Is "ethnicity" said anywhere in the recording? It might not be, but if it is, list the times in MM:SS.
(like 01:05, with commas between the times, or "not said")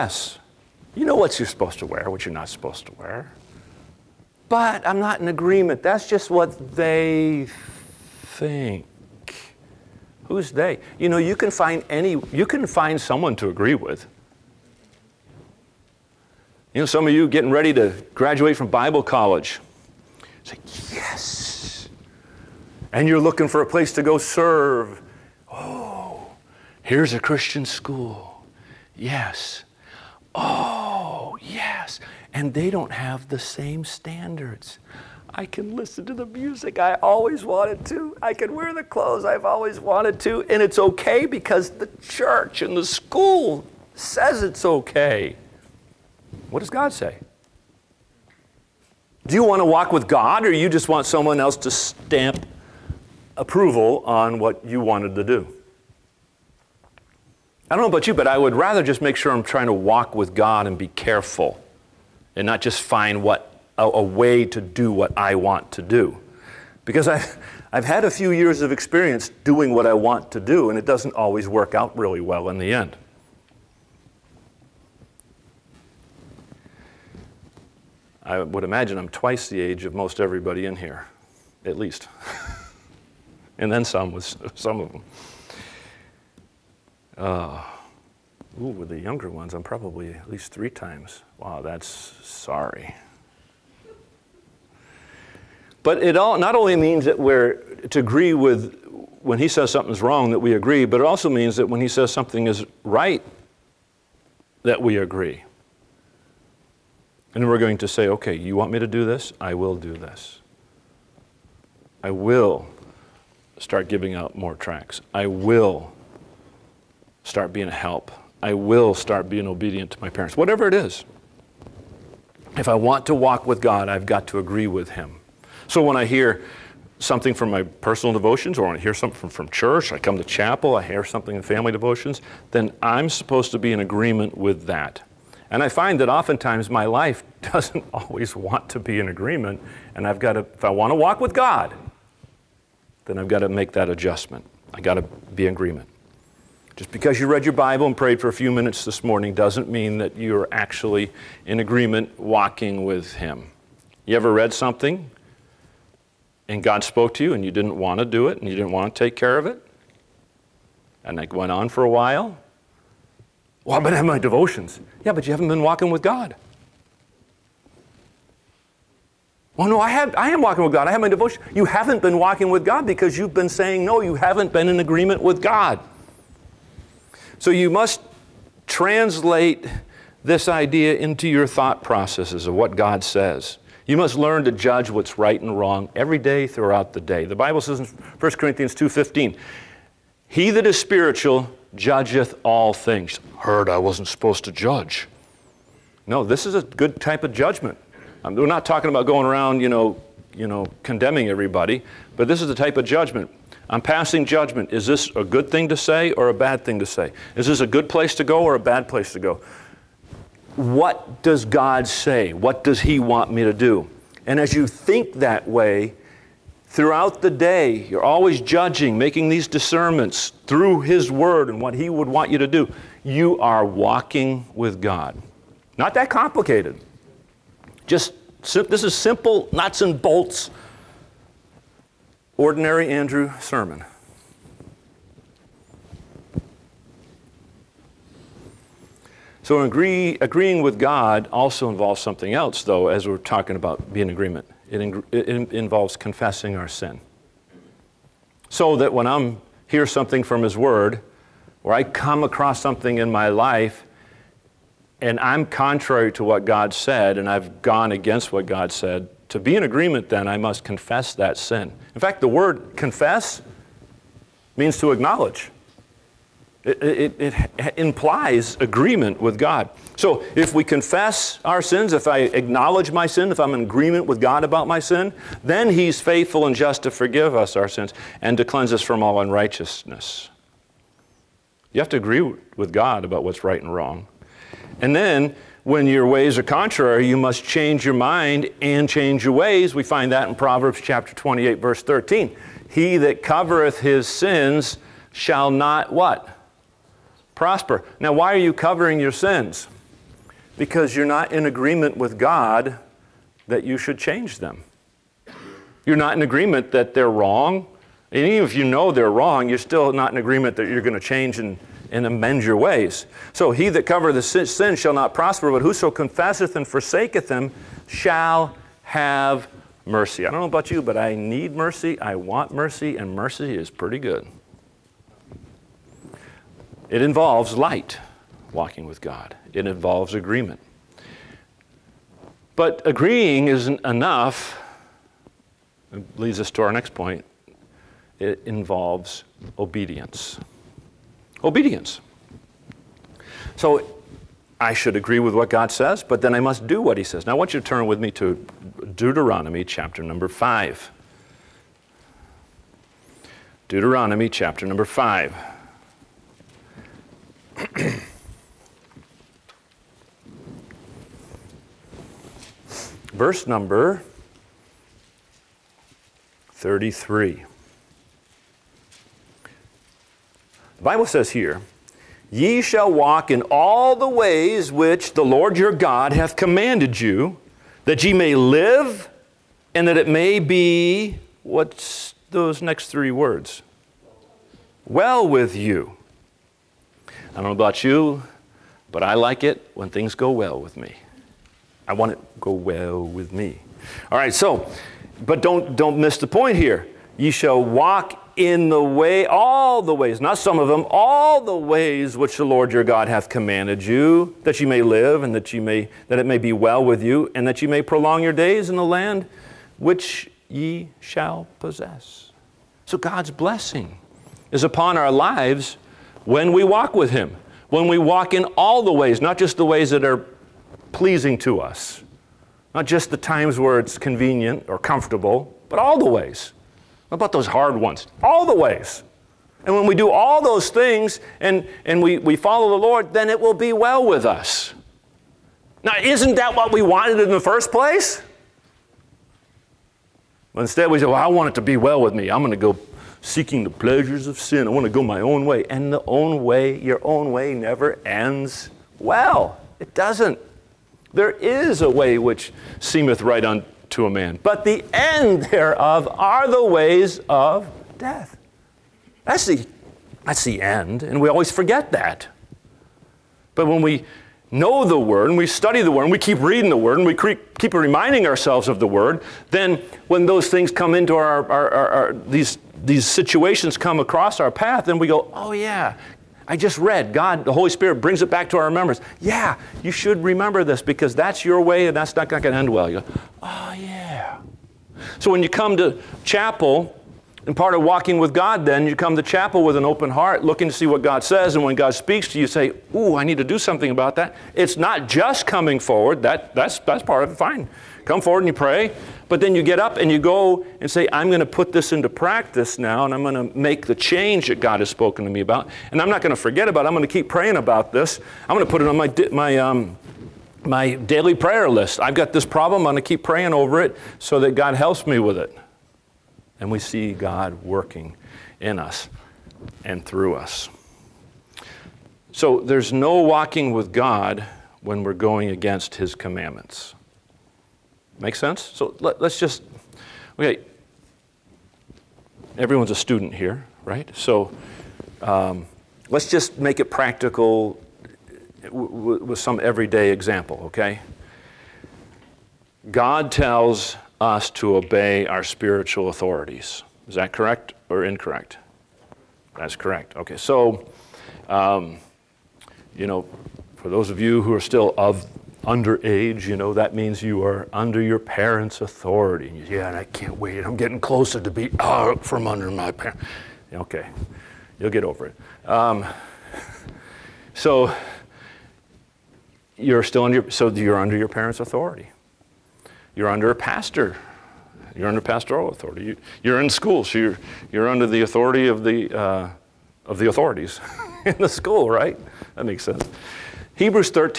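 not said.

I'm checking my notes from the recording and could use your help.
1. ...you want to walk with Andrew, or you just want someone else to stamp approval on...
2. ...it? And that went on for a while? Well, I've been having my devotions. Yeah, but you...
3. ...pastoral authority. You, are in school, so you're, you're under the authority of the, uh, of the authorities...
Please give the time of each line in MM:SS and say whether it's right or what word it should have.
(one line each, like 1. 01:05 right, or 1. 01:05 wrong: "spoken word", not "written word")
1. 00:49 wrong: "God", not "Andrew"
2. 02:39 right
3. 09:35 right.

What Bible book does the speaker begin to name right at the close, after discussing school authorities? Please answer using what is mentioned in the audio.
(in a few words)
Hebrews.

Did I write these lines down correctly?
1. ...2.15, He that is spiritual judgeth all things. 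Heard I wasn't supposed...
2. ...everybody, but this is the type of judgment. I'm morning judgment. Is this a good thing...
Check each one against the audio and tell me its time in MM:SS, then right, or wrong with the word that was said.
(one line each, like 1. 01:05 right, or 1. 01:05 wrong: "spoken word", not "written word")
1. 03:08 right
2. 03:21 wrong: "passing", not "morning".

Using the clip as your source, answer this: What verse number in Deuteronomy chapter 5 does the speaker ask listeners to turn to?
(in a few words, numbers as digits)
33.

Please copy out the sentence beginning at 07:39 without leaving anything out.
That's the, that's the end, and we always forget that.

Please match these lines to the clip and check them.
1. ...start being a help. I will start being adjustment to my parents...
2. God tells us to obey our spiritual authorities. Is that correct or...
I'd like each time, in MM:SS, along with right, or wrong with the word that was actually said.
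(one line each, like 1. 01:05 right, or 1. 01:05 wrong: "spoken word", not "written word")
1. 01:57 wrong: "obedient", not "adjustment"
2. 09:02 right.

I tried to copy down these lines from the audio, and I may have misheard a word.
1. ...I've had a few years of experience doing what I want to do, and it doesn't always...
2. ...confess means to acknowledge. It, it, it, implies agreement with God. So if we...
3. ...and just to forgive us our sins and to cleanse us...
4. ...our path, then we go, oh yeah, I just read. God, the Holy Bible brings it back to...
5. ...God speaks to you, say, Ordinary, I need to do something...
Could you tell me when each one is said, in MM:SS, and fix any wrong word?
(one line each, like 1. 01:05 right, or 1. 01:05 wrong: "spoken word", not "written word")
1. 01:07 right
2. 04:22 right
3. 04:36 right
4. 07:54 wrong: "Spirit", not "Bible"
5. 08:11 wrong: "Ooh", not "Ordinary".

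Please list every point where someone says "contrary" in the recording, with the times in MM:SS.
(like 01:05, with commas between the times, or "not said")
04:15, 04:46.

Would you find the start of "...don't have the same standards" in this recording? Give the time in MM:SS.
00:32.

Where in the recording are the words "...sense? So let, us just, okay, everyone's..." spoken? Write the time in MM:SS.
08:48.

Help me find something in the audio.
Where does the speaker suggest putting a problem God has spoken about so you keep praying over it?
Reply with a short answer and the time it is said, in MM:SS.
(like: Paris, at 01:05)
daily prayer list, at 08:30.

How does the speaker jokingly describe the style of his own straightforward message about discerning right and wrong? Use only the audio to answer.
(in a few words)
Ordinary Andrew Sermon.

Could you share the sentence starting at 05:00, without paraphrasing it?
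Because you're not in agreement with God that you should change them.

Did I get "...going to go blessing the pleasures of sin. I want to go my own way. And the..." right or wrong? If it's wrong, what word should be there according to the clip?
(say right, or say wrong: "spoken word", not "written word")
wrong: "seeking", not "blessing".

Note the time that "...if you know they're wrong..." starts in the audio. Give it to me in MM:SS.
05:08.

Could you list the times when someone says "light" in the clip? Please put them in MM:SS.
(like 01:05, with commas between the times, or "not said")
05:27.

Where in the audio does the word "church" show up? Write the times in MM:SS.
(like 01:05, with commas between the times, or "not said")
00:42, 02:09.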